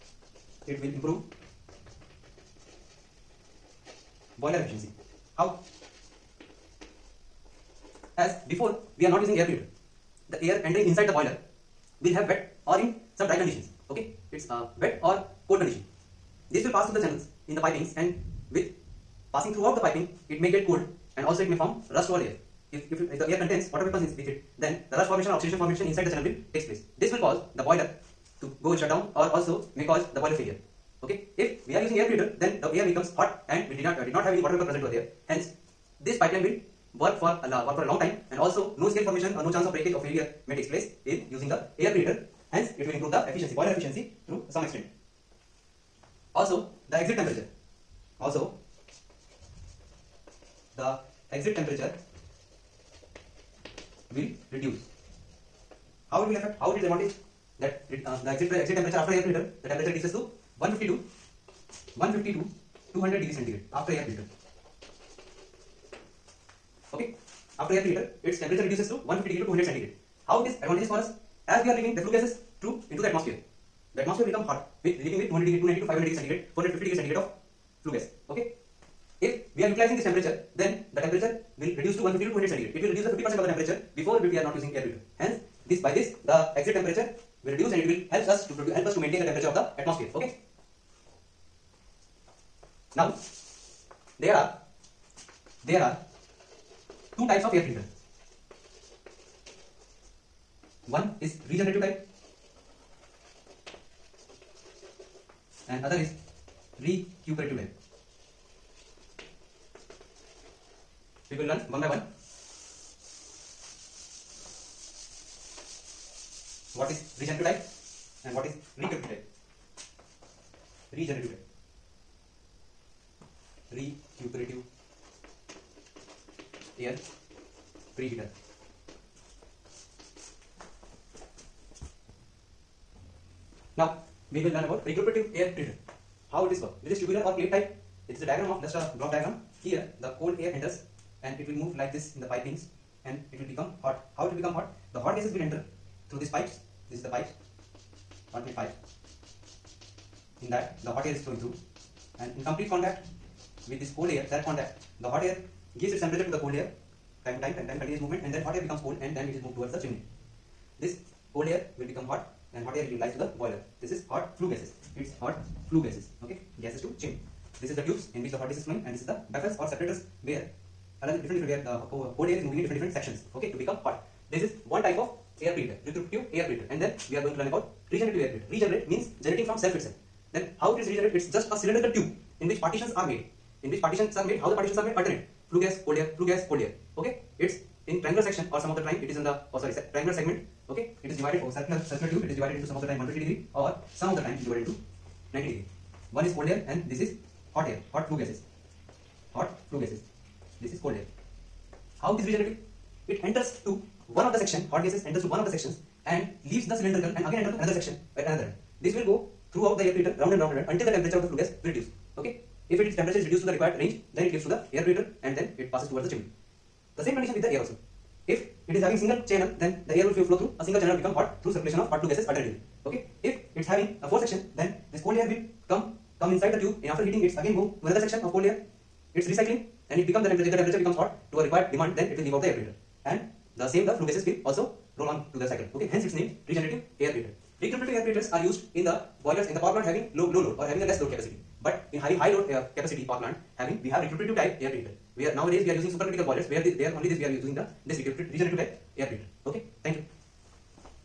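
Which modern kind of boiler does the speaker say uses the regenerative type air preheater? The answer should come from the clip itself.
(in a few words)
supercritical boilers.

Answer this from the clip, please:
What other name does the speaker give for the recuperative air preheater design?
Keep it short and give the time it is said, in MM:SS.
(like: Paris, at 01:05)
tubular or plate type, at 02:17.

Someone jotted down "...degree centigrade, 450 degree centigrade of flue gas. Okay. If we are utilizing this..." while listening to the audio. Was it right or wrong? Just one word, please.
right.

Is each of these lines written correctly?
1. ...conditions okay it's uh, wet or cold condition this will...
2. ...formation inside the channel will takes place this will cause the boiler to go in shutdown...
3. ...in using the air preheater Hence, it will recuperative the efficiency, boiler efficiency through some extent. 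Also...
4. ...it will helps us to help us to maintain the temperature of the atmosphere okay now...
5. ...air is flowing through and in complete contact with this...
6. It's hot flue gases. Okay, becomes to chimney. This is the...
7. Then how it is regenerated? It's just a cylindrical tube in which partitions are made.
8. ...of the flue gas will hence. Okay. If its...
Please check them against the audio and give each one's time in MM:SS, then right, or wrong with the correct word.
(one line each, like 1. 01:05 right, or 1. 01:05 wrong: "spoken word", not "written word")
1. 00:13 right
2. 00:25 right
3. 00:41 wrong: "improve", not "recuperative"
4. 01:27 right
5. 02:31 right
6. 02:44 wrong: "gases", not "becomes"
7. 03:00 right
8. 03:31 wrong: "reduce", not "hence".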